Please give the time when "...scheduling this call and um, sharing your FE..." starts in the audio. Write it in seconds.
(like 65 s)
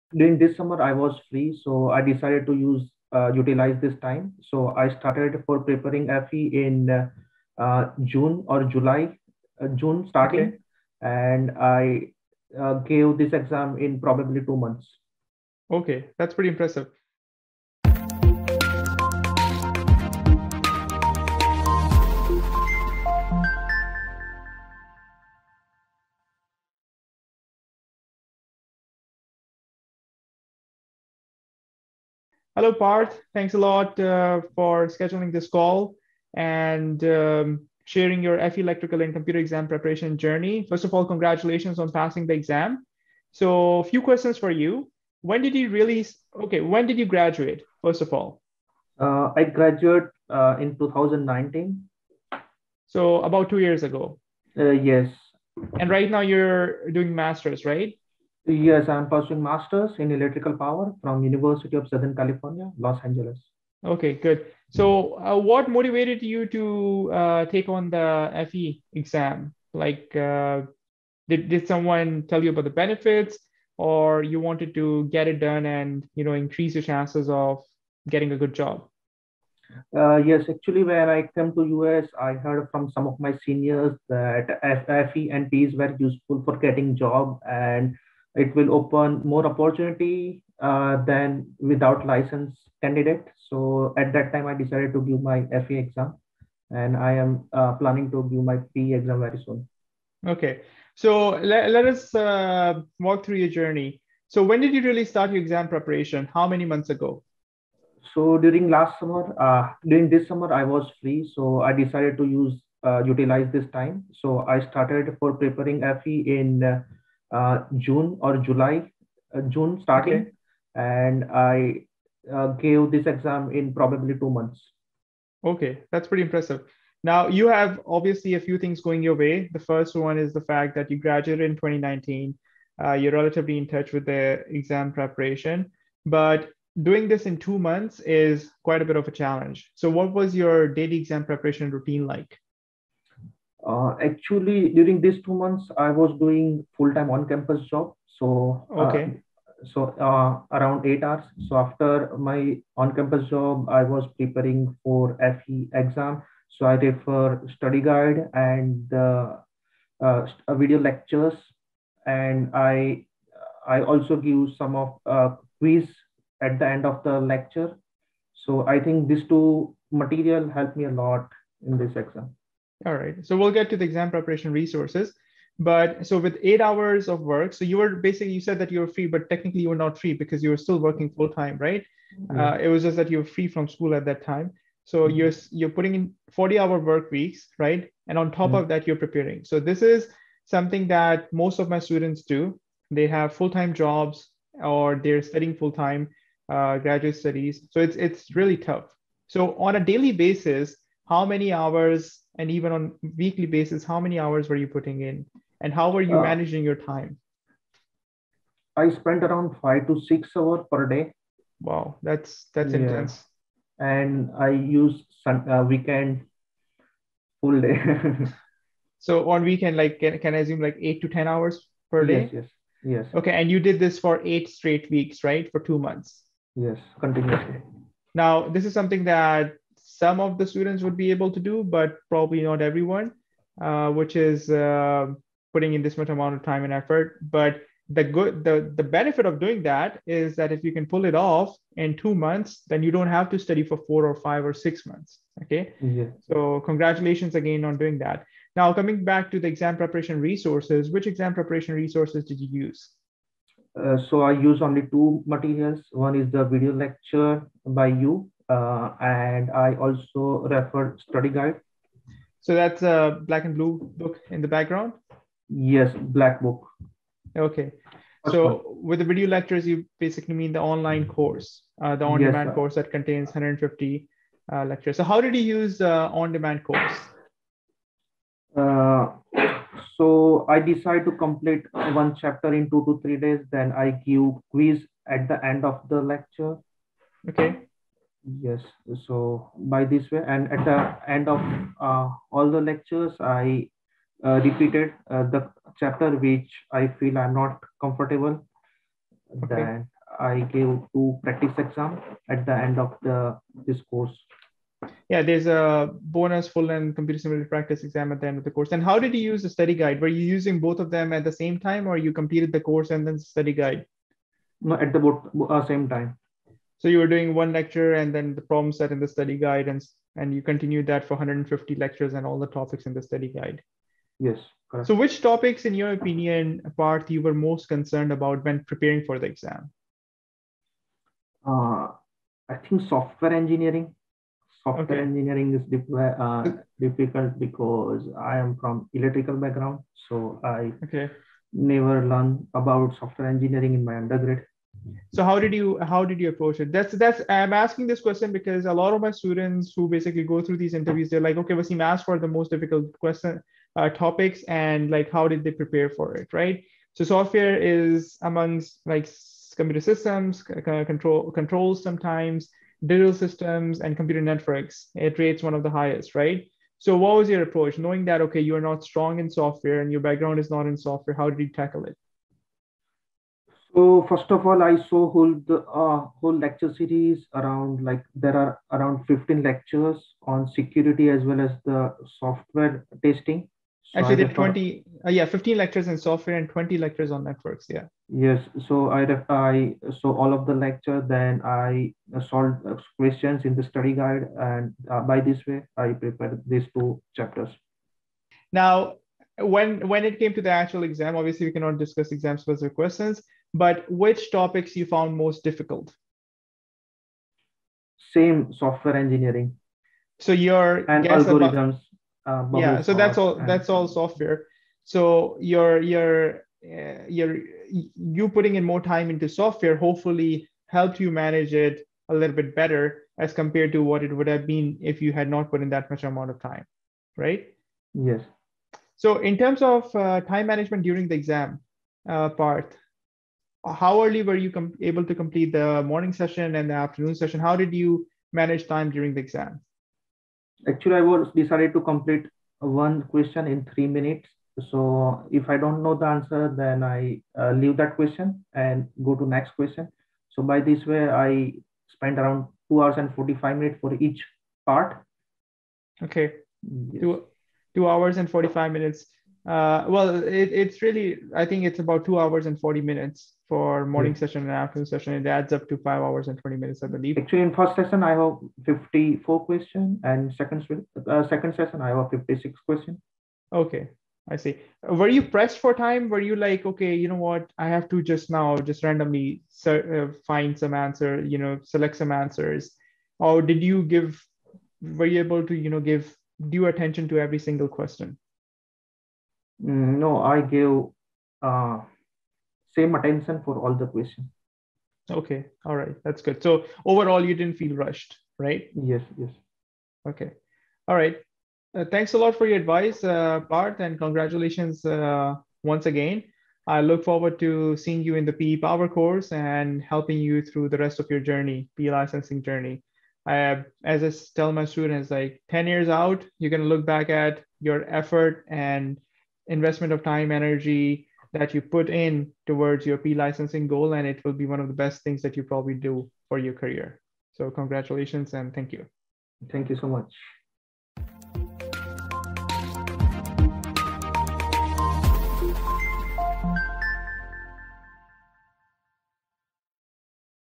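34 s.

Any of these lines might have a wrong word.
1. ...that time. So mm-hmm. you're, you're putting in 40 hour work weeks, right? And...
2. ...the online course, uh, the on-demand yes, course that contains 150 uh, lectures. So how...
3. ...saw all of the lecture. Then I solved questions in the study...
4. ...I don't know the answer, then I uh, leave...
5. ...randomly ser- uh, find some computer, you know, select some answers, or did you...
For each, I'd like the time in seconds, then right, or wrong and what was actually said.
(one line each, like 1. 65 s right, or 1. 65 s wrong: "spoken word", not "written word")
1. 184 s right
2. 270 s right
3. 389 s right
4. 445 s right
5. 478 s wrong: "answer", not "computer".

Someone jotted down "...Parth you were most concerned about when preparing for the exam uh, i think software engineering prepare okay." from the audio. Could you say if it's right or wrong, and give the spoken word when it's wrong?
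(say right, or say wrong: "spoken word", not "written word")
wrong: "software", not "prepare".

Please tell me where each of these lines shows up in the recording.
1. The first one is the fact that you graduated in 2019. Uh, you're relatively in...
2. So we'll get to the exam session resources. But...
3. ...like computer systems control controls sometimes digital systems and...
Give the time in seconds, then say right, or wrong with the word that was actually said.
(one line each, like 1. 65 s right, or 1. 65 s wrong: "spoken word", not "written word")
1. 129 s right
2. 173 s wrong: "preparation", not "session"
3. 358 s right.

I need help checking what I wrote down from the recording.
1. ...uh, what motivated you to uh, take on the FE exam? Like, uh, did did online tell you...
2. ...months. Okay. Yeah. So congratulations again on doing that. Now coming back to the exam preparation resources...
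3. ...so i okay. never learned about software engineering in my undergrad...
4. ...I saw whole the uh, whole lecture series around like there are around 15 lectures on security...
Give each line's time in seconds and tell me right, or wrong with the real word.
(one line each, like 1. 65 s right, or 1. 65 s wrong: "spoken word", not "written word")
1. 65 s wrong: "someone", not "online"
2. 244 s right
3. 340 s right
4. 374 s right.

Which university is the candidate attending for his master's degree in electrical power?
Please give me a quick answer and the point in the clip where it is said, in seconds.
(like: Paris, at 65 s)
University of Southern California, at 61 s.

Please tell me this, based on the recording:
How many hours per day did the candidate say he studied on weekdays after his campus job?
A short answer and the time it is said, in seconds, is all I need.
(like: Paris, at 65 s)
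5 to 6 hours, at 208 s.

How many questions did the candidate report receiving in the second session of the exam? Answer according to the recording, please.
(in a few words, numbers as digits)
56.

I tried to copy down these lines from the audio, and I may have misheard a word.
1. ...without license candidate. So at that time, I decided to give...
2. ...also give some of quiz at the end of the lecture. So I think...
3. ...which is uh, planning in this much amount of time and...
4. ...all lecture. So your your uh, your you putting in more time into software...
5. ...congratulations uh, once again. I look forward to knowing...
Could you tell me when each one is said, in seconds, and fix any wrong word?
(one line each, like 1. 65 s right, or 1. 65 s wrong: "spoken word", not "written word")
1. 91 s right
2. 163 s right
3. 233 s wrong: "putting", not "planning"
4. 413 s wrong: "software", not "lecture"
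5. 503 s wrong: "seeing", not "knowing".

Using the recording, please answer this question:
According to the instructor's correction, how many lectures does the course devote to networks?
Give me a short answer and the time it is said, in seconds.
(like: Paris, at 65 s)
20, at 386 s.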